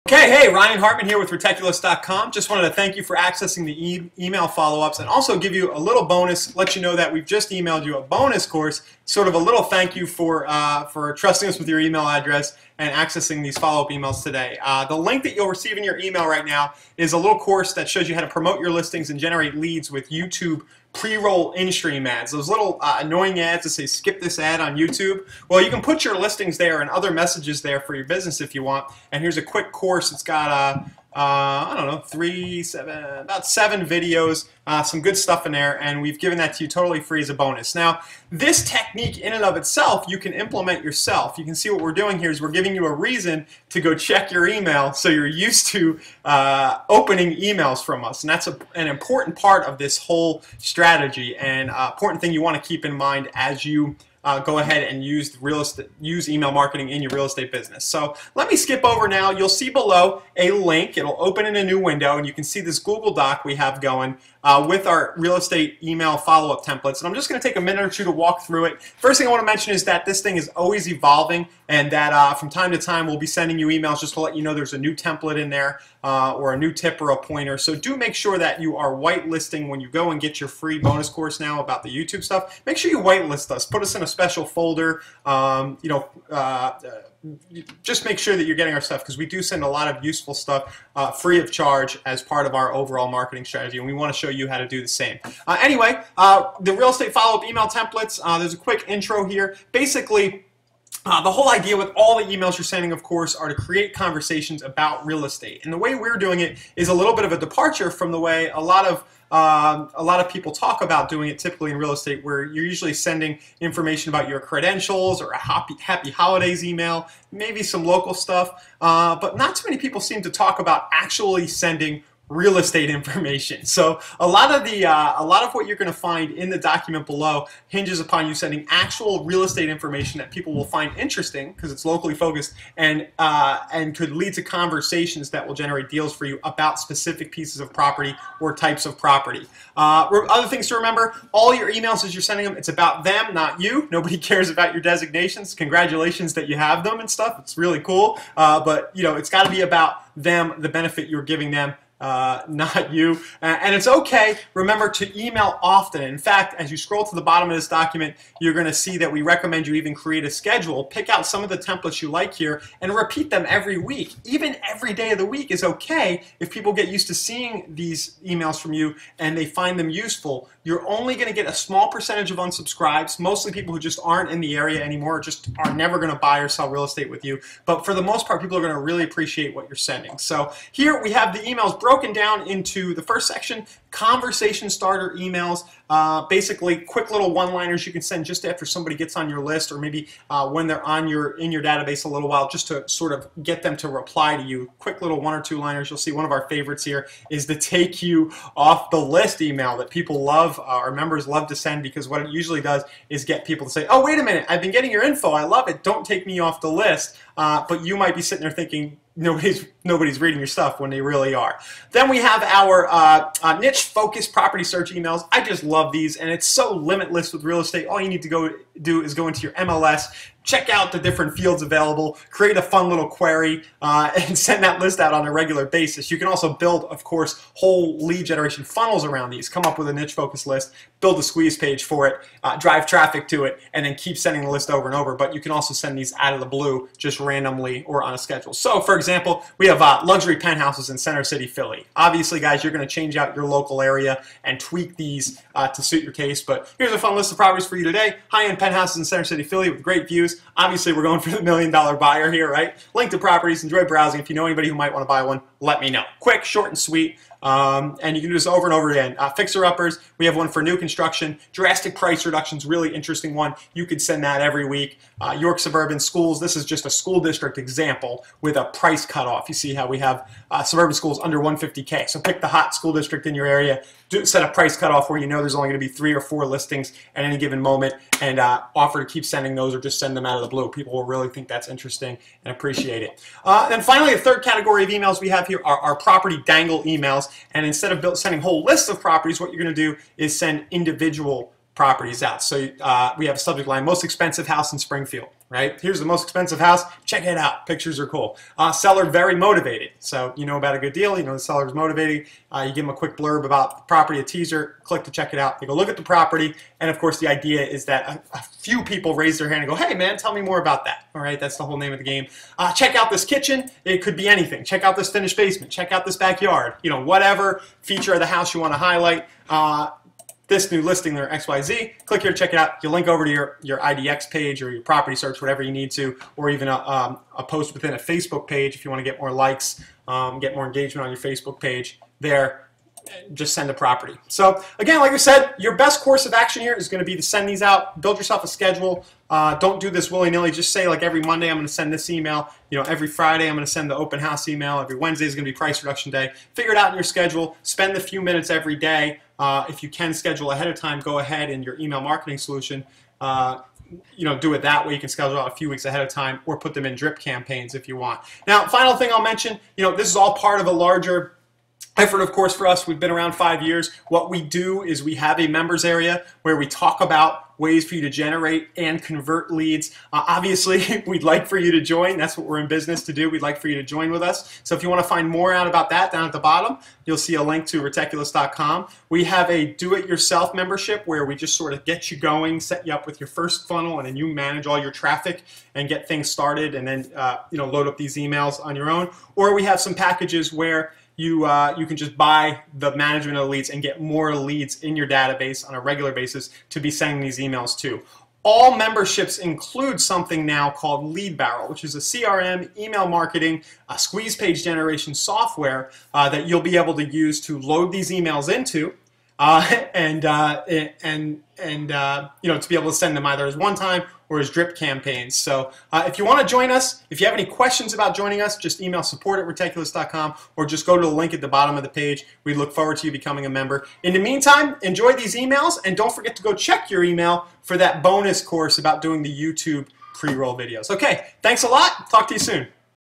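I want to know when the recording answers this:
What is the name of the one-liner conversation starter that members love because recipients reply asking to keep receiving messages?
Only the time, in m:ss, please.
3:17.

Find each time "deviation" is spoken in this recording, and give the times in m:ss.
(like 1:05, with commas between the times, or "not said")
not said.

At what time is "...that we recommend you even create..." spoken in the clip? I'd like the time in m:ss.
2:38.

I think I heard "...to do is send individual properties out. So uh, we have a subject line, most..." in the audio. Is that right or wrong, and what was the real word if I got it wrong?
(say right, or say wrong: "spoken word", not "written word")
right.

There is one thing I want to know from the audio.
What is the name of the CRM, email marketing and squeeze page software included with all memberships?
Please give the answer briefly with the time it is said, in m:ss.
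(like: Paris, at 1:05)
Lead Barrel, at 6:41.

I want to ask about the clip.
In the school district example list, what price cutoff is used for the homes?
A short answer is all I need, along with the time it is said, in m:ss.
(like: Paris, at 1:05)
150K, at 4:31.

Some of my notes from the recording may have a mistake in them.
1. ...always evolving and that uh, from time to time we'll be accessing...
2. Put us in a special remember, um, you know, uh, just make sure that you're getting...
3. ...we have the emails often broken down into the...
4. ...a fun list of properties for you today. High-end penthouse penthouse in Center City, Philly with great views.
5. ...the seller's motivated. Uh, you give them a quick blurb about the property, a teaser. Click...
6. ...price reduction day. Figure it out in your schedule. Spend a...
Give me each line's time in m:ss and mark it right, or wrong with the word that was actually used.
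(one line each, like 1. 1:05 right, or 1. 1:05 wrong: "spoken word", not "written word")
1. 1:10 wrong: "sending", not "accessing"
2. 1:23 wrong: "folder", not "remember"
3. 3:01 wrong: "broken", not "often"
4. 4:06 right
5. 5:01 right
6. 5:45 right.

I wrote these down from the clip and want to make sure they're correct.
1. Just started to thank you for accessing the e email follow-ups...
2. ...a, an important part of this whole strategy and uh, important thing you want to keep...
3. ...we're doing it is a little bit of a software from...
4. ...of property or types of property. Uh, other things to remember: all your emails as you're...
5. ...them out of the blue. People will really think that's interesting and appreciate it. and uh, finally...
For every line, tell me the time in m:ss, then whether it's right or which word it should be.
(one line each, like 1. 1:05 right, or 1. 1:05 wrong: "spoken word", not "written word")
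1. 0:02 wrong: "wanted", not "started"
2. 0:48 right
3. 1:45 wrong: "departure", not "software"
4. 2:17 right
5. 4:40 right.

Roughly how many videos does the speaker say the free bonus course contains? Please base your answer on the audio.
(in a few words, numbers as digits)
7.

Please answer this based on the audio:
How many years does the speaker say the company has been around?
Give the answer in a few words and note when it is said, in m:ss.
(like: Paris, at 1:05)
5, at 6:03.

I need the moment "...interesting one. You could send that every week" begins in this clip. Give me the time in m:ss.
4:22.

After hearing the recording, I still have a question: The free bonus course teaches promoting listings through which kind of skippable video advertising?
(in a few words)
YouTube pre-roll in-stream ads.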